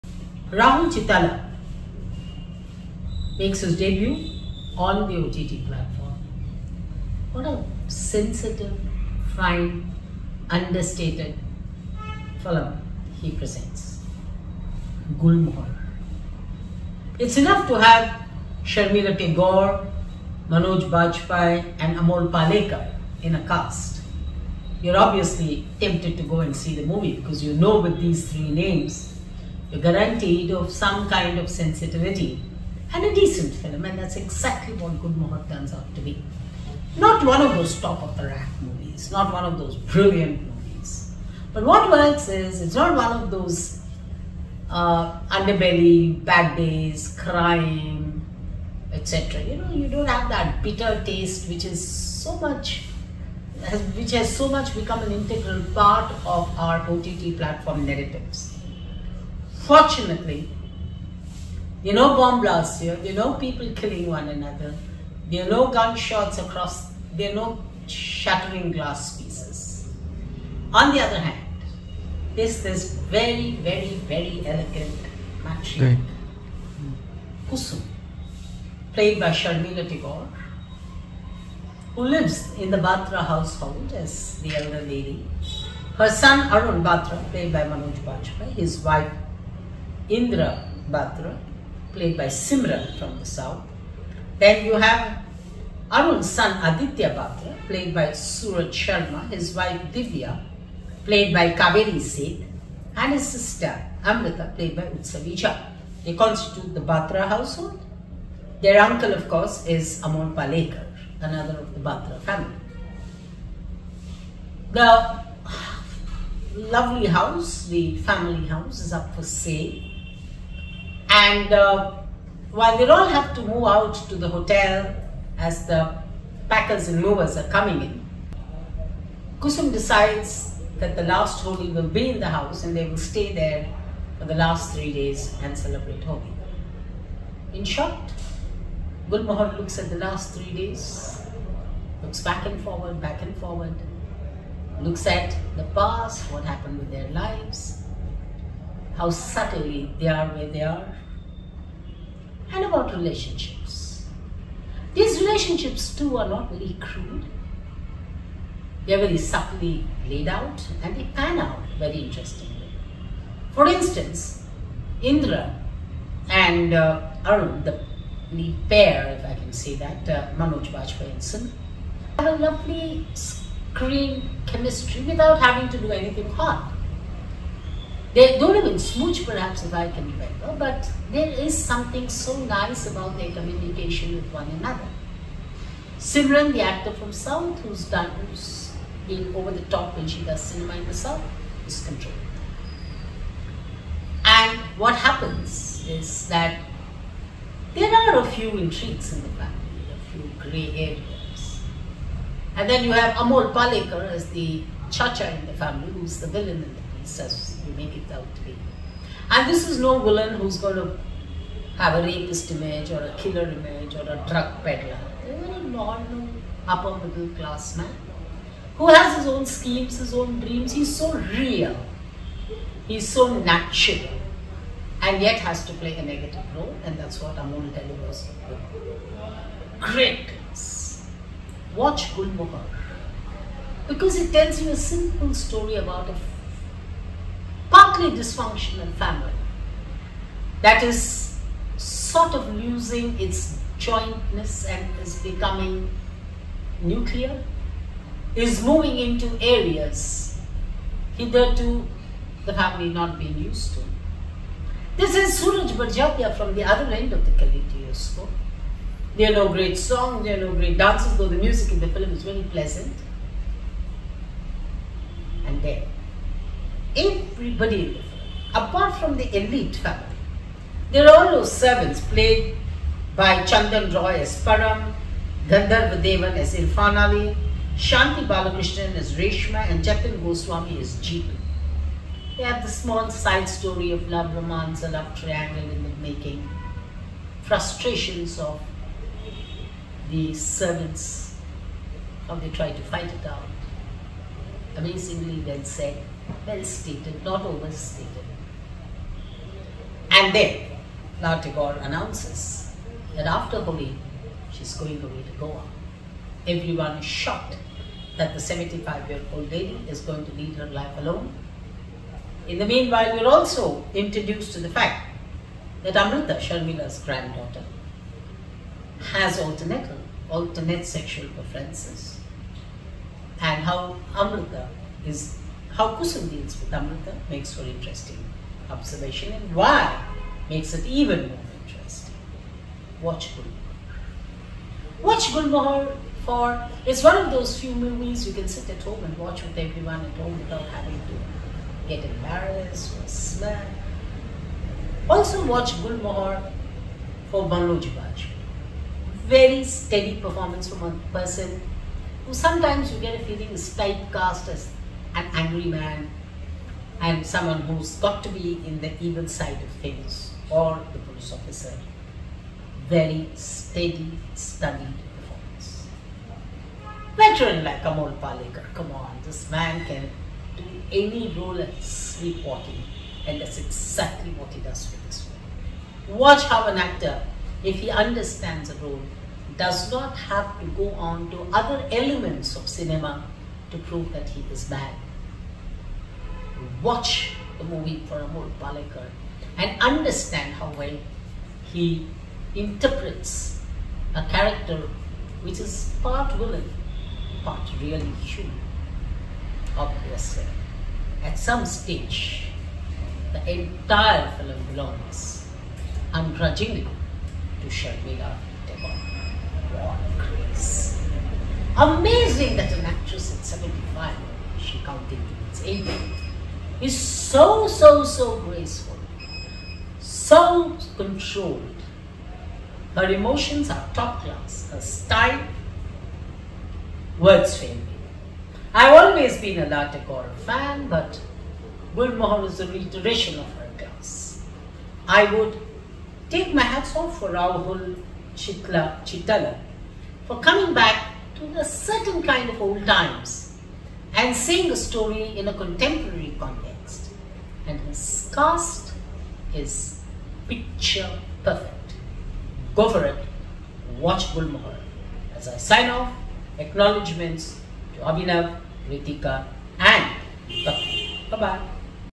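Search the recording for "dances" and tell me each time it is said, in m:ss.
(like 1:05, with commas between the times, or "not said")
4:20.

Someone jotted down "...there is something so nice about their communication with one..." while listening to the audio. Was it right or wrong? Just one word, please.
right.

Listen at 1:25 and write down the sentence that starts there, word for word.
Her son Arun Batra, played by Manoj Bajpayee, his wife Indra Batra, played by Simran from the south.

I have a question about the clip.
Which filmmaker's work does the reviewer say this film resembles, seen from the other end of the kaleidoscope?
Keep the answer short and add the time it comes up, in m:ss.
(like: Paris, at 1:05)
Sooraj Barjatya, at 4:15.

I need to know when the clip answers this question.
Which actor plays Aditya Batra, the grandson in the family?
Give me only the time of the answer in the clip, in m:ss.
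1:38.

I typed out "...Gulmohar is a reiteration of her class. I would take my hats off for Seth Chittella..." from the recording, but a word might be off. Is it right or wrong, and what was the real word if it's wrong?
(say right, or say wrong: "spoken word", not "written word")
wrong: "Rahul", not "Seth".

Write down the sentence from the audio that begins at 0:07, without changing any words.
What a sensitive, fine, understated film he presents.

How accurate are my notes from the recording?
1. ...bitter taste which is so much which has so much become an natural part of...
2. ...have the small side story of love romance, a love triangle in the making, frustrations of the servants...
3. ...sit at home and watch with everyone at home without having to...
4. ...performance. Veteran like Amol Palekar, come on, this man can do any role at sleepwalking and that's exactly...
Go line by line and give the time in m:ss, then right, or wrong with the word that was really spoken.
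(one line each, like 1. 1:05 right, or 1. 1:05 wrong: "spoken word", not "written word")
1. 0:50 wrong: "integral", not "natural"
2. 4:42 right
3. 5:38 right
4. 6:05 right.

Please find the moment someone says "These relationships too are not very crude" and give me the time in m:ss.
2:34.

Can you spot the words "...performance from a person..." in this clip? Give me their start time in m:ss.
5:50.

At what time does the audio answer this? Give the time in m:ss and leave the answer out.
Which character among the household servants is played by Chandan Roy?
4:34.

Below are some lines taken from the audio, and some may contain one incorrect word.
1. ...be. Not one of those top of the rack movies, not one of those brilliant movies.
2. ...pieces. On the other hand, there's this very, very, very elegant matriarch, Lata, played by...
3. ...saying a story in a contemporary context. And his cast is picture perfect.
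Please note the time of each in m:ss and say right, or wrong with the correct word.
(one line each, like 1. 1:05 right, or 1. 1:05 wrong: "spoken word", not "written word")
1. 0:36 right
2. 1:09 wrong: "Kusum", not "Lata"
3. 7:24 right.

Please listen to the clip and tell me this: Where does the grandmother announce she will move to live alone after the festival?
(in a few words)
Goa.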